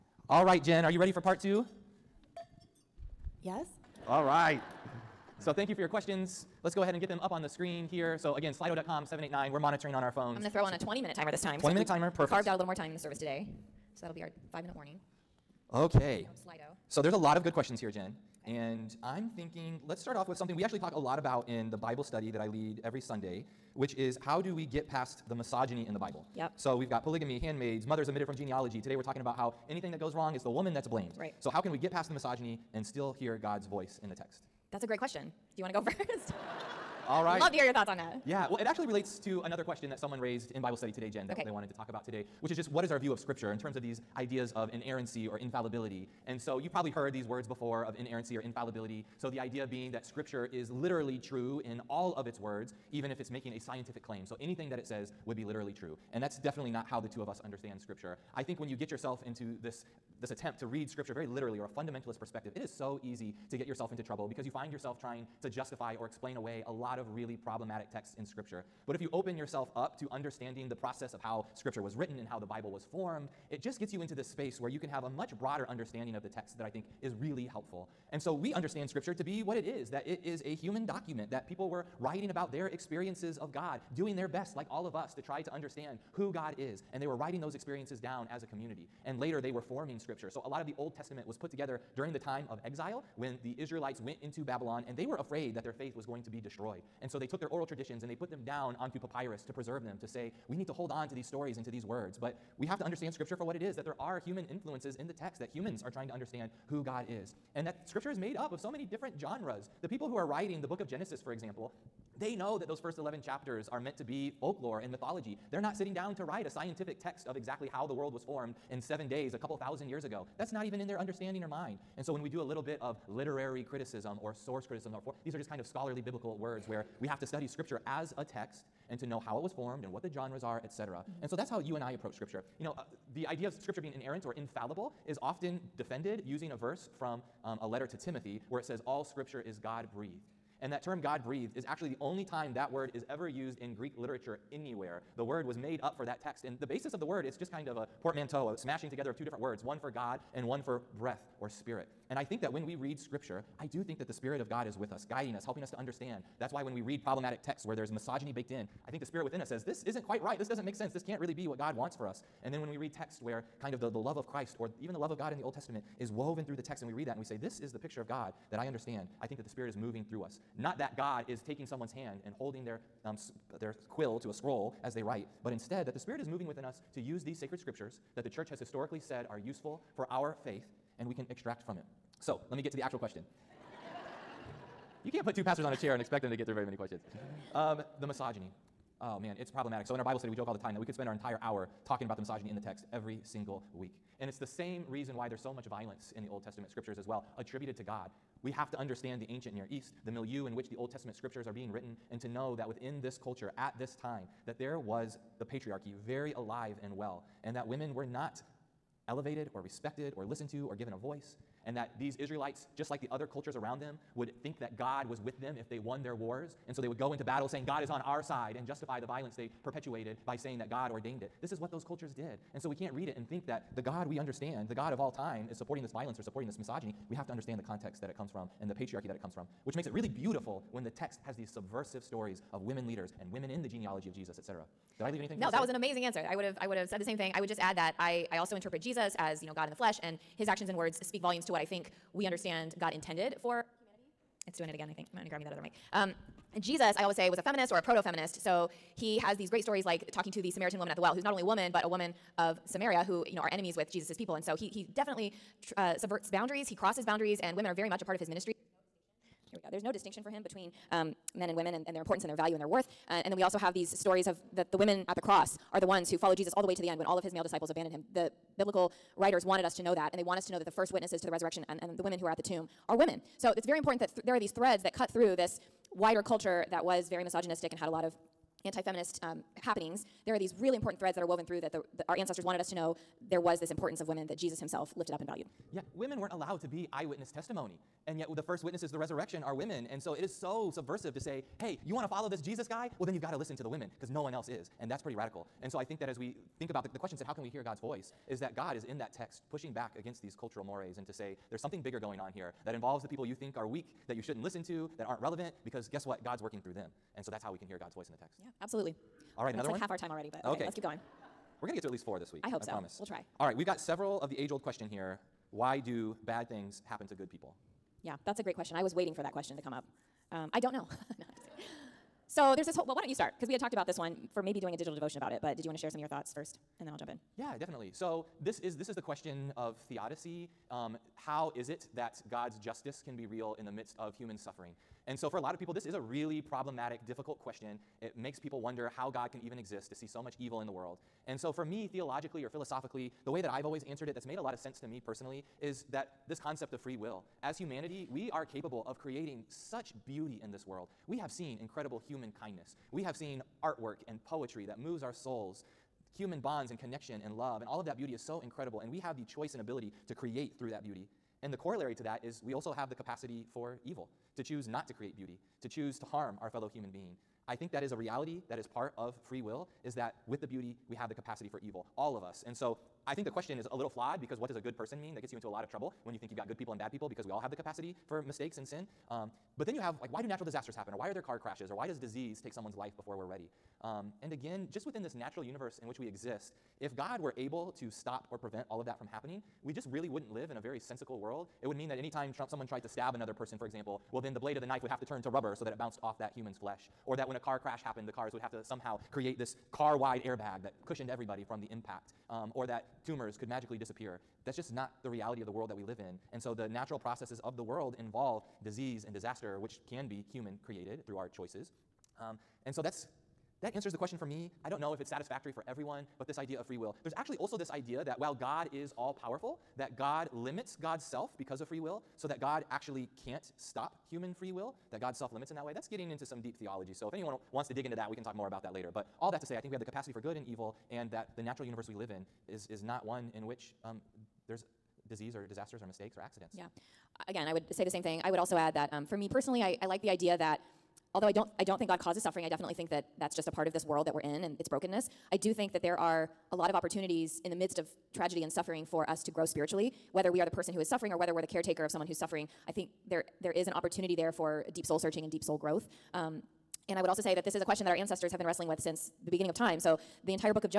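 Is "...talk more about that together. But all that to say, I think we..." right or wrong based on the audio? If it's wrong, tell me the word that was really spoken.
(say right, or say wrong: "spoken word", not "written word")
wrong: "later", not "together".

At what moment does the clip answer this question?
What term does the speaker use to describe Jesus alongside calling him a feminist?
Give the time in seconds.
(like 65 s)
247 s.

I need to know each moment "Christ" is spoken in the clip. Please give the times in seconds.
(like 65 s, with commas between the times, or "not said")
164 s.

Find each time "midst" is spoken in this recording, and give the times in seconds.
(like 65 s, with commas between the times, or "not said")
333 s, 447 s.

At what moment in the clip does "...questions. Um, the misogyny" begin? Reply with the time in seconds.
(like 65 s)
186 s.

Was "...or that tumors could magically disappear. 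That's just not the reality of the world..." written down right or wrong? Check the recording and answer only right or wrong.
right.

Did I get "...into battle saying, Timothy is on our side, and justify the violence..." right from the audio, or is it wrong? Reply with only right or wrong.
wrong.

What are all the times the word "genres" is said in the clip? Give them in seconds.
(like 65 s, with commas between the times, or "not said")
109 s, 130 s.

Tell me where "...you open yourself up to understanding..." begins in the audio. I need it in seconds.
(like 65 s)
68 s.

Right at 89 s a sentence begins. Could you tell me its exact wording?
And later they were forming scripture.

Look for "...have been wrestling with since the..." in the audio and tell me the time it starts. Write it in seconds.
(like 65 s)
458 s.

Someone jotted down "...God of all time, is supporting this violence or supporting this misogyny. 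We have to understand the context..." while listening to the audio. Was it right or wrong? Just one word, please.
right.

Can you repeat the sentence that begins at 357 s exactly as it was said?
And all of that beauty is so incredible.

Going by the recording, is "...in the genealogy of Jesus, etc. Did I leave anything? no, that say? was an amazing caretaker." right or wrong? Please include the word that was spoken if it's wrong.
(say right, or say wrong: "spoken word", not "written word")
wrong: "answer", not "caretaker".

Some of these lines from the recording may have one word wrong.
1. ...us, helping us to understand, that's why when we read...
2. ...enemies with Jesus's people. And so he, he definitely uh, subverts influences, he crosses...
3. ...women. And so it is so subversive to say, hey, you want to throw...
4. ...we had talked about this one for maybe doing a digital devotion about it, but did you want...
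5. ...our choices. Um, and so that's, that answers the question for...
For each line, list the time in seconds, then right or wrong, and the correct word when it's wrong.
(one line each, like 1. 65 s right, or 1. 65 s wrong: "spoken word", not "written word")
1. 155 s right
2. 253 s wrong: "boundaries", not "influences"
3. 289 s wrong: "follow", not "throw"
4. 323 s right
5. 411 s right.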